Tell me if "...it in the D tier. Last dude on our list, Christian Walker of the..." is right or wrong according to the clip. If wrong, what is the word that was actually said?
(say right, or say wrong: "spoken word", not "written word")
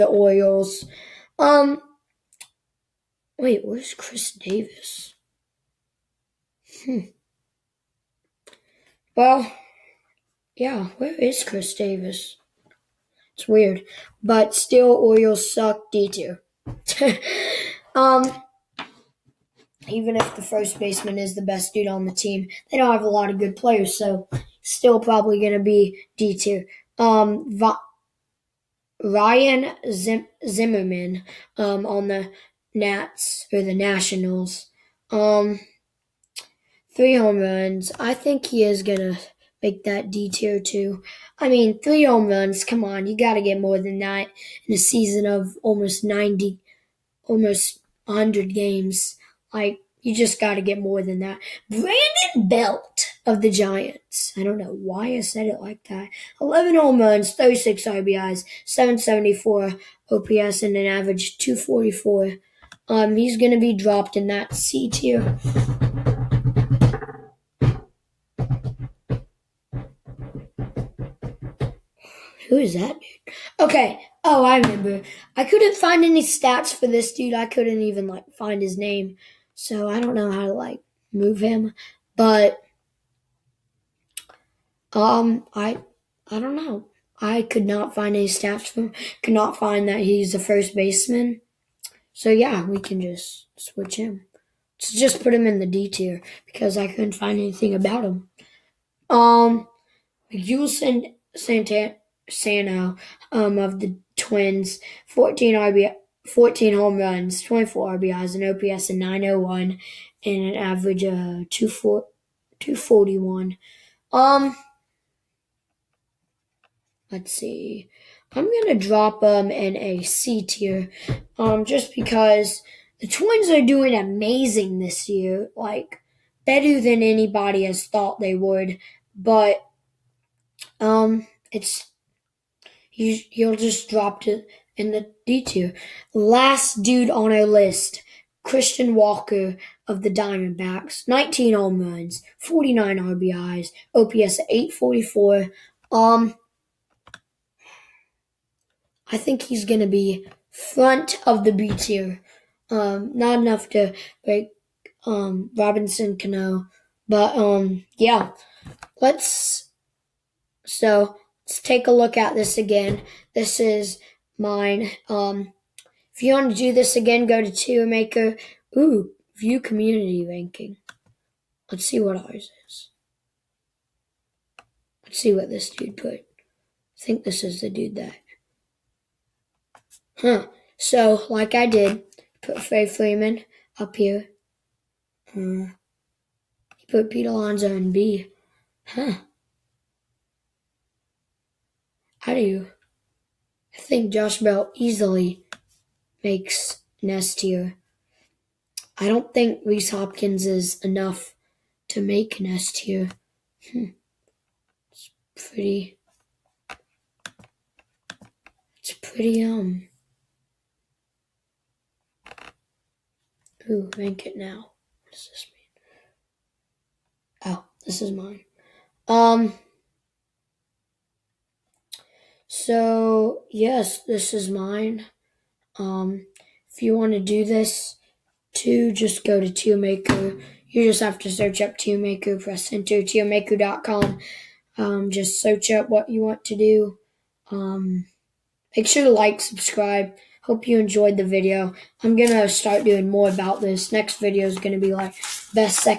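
right.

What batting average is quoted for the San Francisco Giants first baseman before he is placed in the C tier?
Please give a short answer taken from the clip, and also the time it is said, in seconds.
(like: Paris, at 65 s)
244, at 61 s.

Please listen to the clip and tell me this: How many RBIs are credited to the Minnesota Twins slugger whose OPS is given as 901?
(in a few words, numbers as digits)
24.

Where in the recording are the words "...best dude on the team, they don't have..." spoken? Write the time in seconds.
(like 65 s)
21 s.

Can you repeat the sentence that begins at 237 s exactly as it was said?
Um, make sure to like, subscribe.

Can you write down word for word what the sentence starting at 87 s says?
I could not find any stats for him.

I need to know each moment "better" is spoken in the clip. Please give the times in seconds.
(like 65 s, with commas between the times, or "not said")
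126 s.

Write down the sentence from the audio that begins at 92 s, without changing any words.
So yeah, we can just switch him.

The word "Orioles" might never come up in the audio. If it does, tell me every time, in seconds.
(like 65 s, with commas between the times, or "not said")
0 s, 14 s.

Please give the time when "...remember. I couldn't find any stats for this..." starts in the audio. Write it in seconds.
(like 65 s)
74 s.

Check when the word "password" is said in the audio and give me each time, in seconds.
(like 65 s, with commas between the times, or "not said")
not said.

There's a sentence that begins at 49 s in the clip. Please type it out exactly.
Like, you just got to get more than that.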